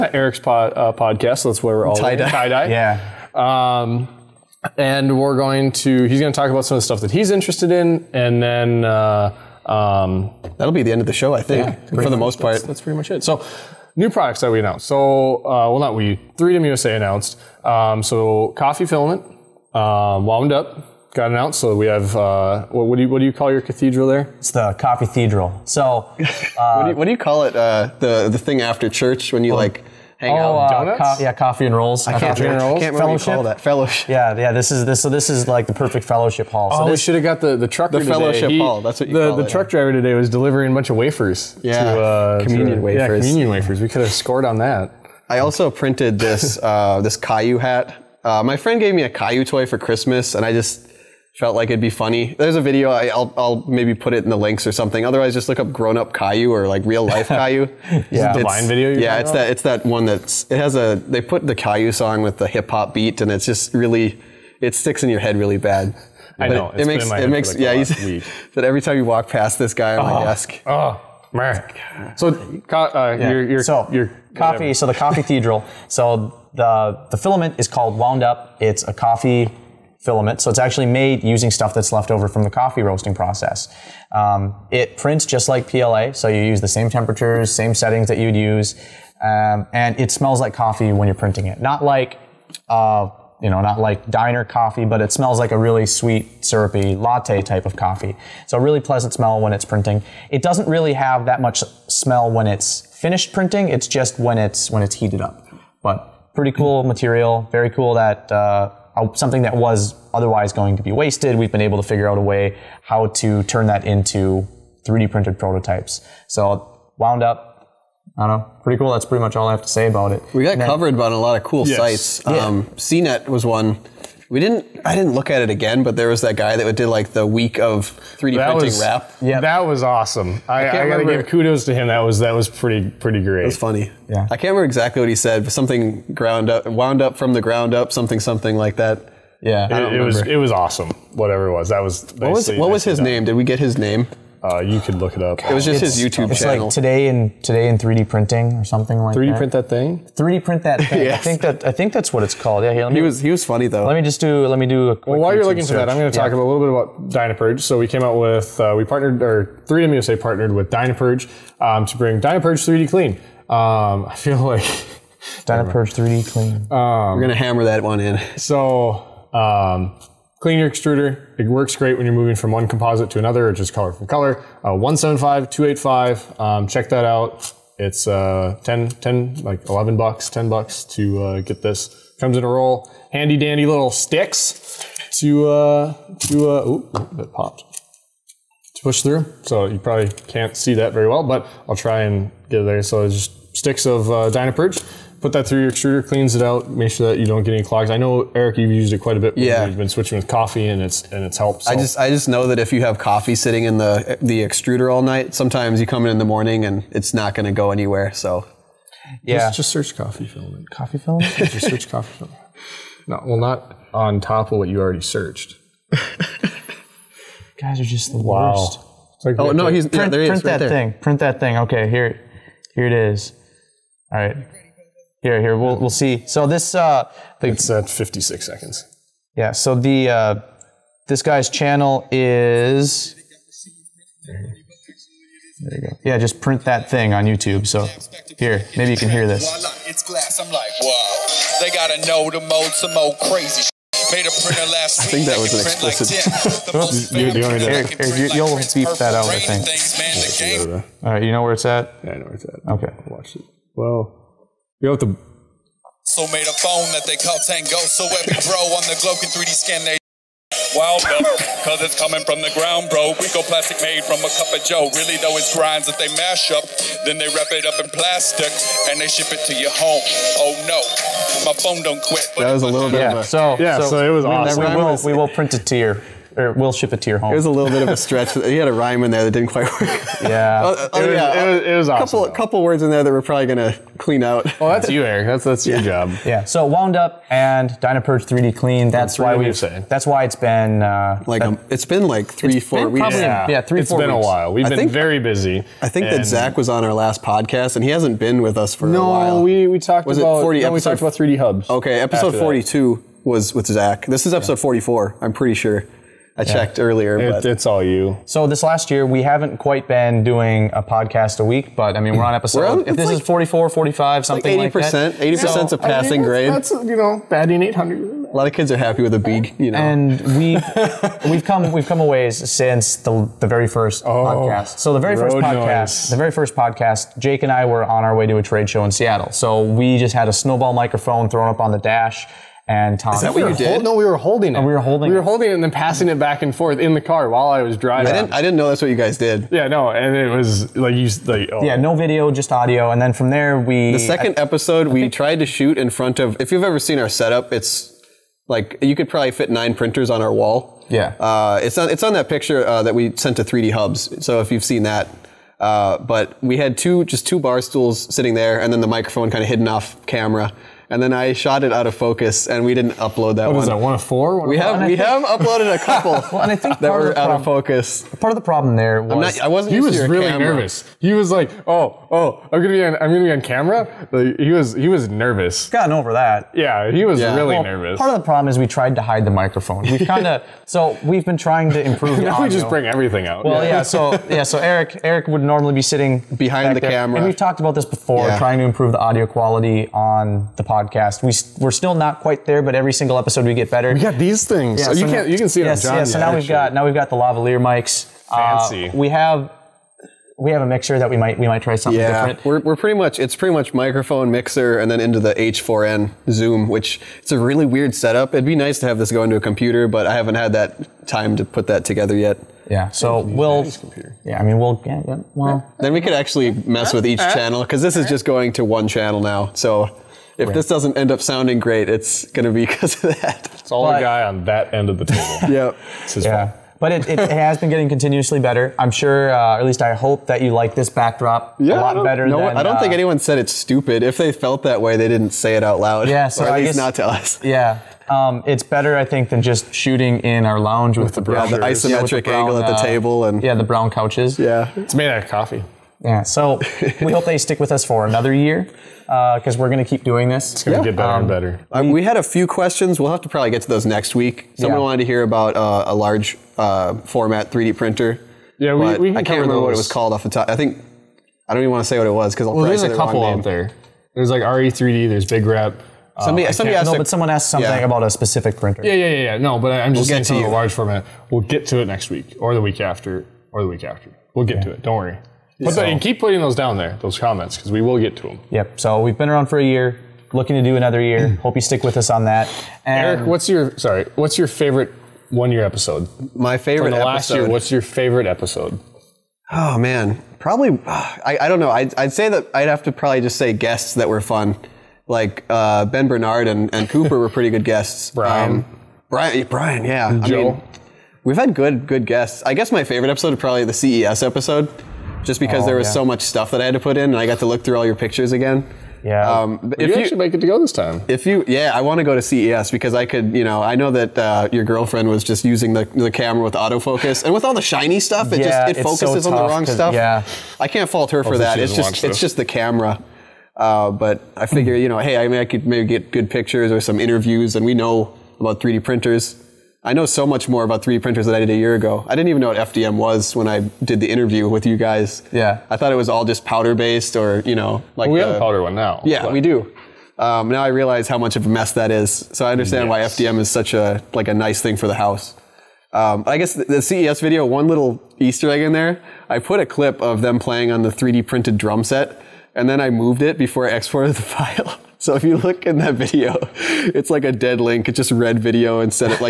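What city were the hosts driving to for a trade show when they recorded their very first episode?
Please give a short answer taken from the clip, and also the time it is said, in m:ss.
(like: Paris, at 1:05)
Seattle, at 5:28.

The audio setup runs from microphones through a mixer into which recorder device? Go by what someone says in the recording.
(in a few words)
H4n Zoom.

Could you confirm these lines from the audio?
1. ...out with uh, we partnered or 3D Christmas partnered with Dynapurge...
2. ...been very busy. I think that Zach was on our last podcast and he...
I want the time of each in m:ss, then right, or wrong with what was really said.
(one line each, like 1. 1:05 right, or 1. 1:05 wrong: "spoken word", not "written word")
1. 2:38 wrong: "USA", not "Christmas"
2. 4:54 right.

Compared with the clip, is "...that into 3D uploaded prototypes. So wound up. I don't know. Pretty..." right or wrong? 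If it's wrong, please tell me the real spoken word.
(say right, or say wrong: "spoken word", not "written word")
wrong: "printed", not "uploaded".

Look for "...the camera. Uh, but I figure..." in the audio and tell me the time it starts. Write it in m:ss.
8:42.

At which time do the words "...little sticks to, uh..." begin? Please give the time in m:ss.
3:03.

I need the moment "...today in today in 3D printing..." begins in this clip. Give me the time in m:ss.
2:26.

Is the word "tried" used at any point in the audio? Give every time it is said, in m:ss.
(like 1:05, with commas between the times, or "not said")
5:45, 6:18.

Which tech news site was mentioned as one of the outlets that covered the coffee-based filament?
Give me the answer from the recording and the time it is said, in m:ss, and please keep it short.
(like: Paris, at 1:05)
CNET, at 2:02.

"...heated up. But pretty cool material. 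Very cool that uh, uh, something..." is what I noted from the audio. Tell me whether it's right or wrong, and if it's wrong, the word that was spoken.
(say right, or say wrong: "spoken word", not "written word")
right.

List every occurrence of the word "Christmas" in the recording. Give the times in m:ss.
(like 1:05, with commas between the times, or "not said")
0:49.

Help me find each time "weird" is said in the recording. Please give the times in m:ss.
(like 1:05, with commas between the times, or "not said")
6:47.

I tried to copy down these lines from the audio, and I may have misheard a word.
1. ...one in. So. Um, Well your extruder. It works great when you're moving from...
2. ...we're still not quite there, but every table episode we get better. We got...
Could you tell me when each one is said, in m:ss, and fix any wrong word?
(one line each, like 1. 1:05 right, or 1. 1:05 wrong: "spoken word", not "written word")
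1. 2:47 wrong: "Clean", not "Well"
2. 6:31 wrong: "single", not "table".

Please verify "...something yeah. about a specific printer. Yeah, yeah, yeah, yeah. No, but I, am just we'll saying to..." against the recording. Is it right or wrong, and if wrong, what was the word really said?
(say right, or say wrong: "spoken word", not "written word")
right.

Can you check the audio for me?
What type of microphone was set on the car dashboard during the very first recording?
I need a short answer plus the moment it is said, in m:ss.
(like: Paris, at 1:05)
snowball microphone, at 5:30.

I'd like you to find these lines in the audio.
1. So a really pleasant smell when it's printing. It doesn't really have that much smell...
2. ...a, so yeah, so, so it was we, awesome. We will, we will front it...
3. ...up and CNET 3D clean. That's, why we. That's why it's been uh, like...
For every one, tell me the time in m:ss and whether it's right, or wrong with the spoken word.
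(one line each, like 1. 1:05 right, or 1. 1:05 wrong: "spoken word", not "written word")
1. 1:38 right
2. 4:33 wrong: "print", not "front"
3. 4:46 wrong: "Dynapurge", not "CNET".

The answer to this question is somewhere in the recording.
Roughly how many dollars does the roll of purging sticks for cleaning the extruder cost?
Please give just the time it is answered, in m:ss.
2:59.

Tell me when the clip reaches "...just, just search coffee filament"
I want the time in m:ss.
3:29.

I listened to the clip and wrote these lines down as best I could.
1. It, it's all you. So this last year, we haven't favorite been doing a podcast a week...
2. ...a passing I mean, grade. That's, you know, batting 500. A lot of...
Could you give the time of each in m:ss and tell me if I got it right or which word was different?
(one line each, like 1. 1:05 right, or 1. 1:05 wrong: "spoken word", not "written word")
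1. 5:07 wrong: "quite", not "favorite"
2. 5:15 wrong: "800", not "500".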